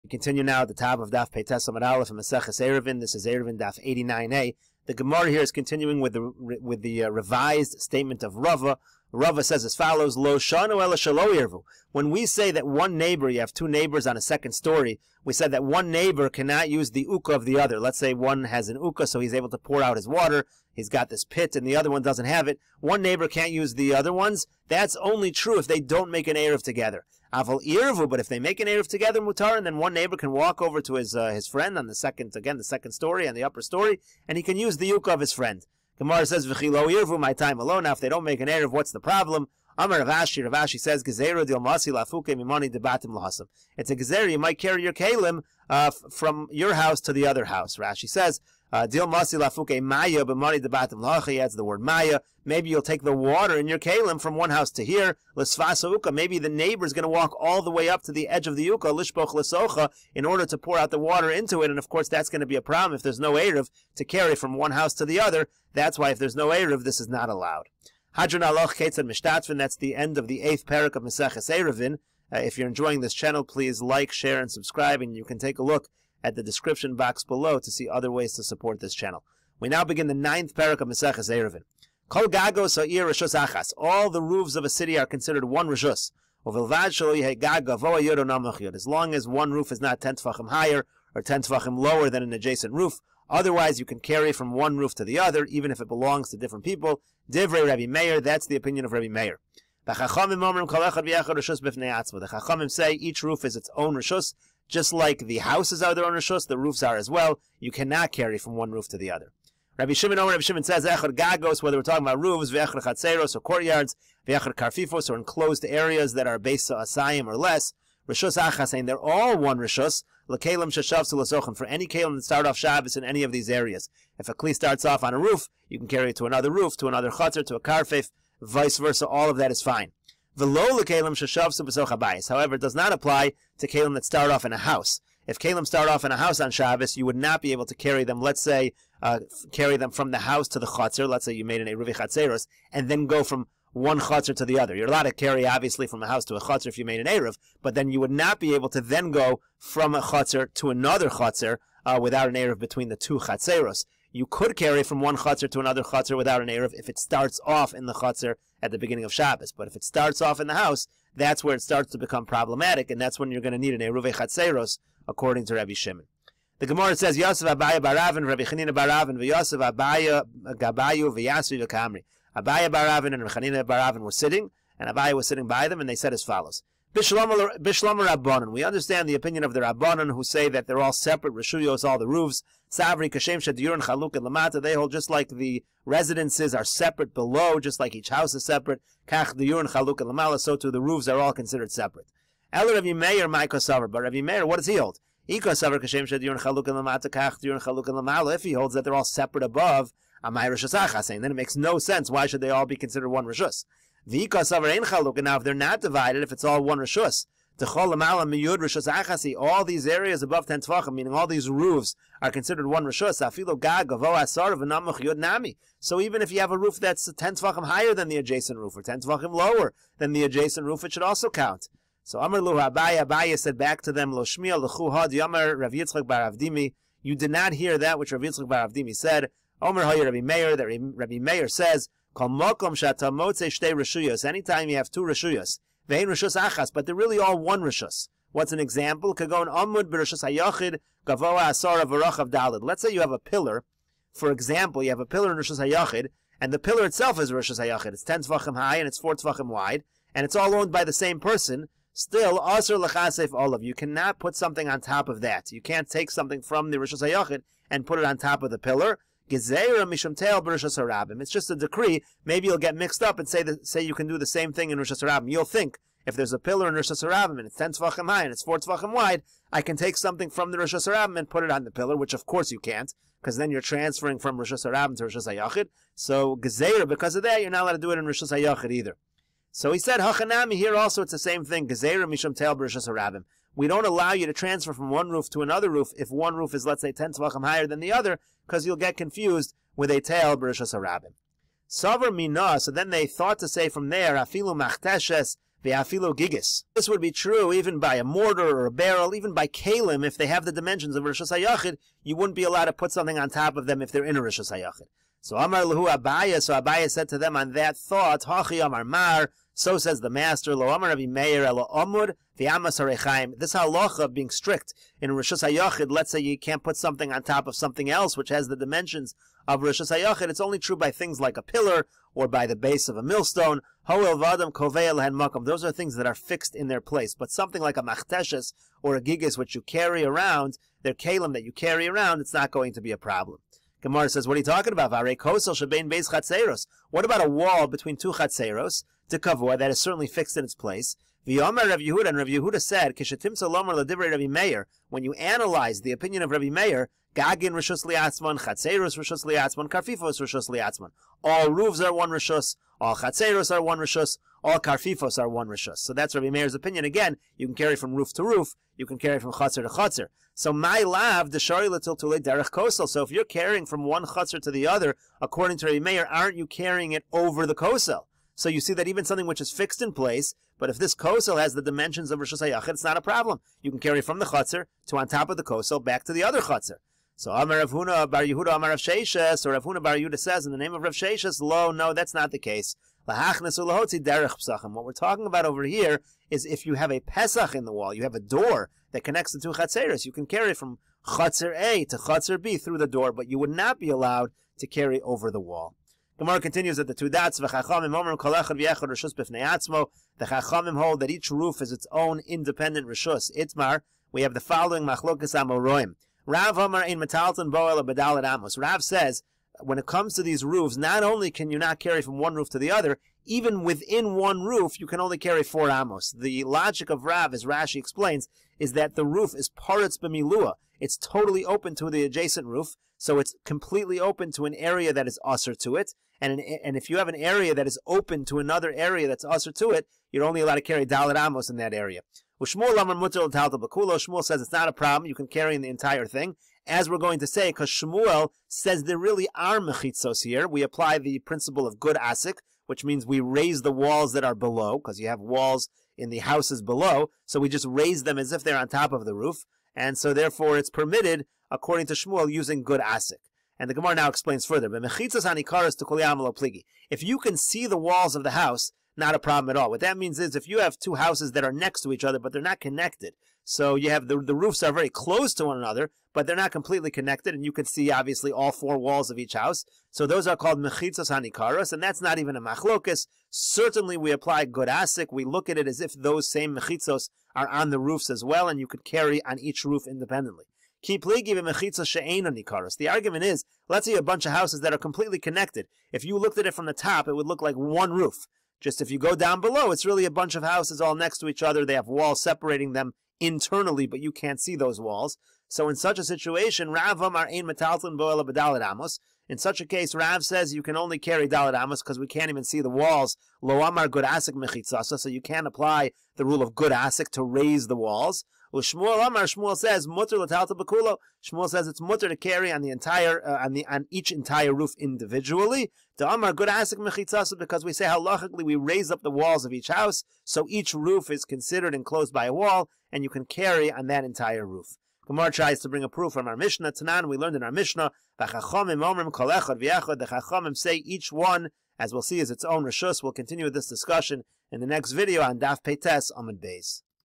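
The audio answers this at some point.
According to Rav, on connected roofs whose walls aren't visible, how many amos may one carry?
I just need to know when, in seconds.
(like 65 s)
430 s.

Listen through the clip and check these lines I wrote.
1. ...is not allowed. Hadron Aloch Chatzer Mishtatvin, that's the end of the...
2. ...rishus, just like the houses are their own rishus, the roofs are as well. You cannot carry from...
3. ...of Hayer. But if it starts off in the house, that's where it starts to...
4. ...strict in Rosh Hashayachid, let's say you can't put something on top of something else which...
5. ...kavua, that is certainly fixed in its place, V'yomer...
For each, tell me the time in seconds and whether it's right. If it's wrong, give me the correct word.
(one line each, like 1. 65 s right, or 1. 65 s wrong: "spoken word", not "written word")
1. 67 s wrong: "Ketzad", not "Chatzer"
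2. 103 s right
3. 159 s wrong: "Shabbos", not "Hayer"
4. 314 s right
5. 339 s right.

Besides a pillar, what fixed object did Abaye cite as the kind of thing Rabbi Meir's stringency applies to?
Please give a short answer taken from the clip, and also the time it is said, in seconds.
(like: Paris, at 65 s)
base of a millstone, at 322 s.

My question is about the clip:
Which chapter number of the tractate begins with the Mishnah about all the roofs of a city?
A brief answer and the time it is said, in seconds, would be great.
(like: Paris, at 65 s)
ninth, at 80 s.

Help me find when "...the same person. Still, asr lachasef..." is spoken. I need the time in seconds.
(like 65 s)
250 s.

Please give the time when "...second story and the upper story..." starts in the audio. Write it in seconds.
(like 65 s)
32 s.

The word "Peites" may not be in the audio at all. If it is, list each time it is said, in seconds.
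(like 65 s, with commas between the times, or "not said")
1 s, 535 s.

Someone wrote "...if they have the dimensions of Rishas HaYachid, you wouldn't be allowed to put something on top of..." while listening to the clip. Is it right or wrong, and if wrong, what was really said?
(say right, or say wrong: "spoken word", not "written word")
right.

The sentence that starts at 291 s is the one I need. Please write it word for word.
Savar mina, so then they thought to say from there, afilu machteshes ve'afilu gigis.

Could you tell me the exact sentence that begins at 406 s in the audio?
Rav omer in metalton boel bedalat amos.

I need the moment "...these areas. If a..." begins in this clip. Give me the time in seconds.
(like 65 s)
123 s.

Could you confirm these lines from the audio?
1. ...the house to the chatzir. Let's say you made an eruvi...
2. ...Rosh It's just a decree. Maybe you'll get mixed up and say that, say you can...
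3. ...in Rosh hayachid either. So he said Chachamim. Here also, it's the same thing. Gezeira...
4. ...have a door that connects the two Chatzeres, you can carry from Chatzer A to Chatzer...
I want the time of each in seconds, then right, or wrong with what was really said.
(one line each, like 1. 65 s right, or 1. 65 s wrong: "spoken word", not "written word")
1. 140 s right
2. 260 s right
3. 277 s wrong: "Hachanami", not "Chachamim"
4. 388 s right.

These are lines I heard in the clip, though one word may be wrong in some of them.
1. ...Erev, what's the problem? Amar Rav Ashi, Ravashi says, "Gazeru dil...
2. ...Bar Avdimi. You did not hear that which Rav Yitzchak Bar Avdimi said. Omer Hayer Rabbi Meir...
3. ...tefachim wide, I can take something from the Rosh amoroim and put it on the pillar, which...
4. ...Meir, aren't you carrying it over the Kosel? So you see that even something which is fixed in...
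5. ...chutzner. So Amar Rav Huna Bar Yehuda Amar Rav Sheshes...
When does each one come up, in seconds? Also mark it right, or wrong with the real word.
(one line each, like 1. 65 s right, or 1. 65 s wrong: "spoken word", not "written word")
1. 38 s right
2. 226 s right
3. 268 s wrong: "harabim", not "amoroim"
4. 365 s right
5. 376 s right.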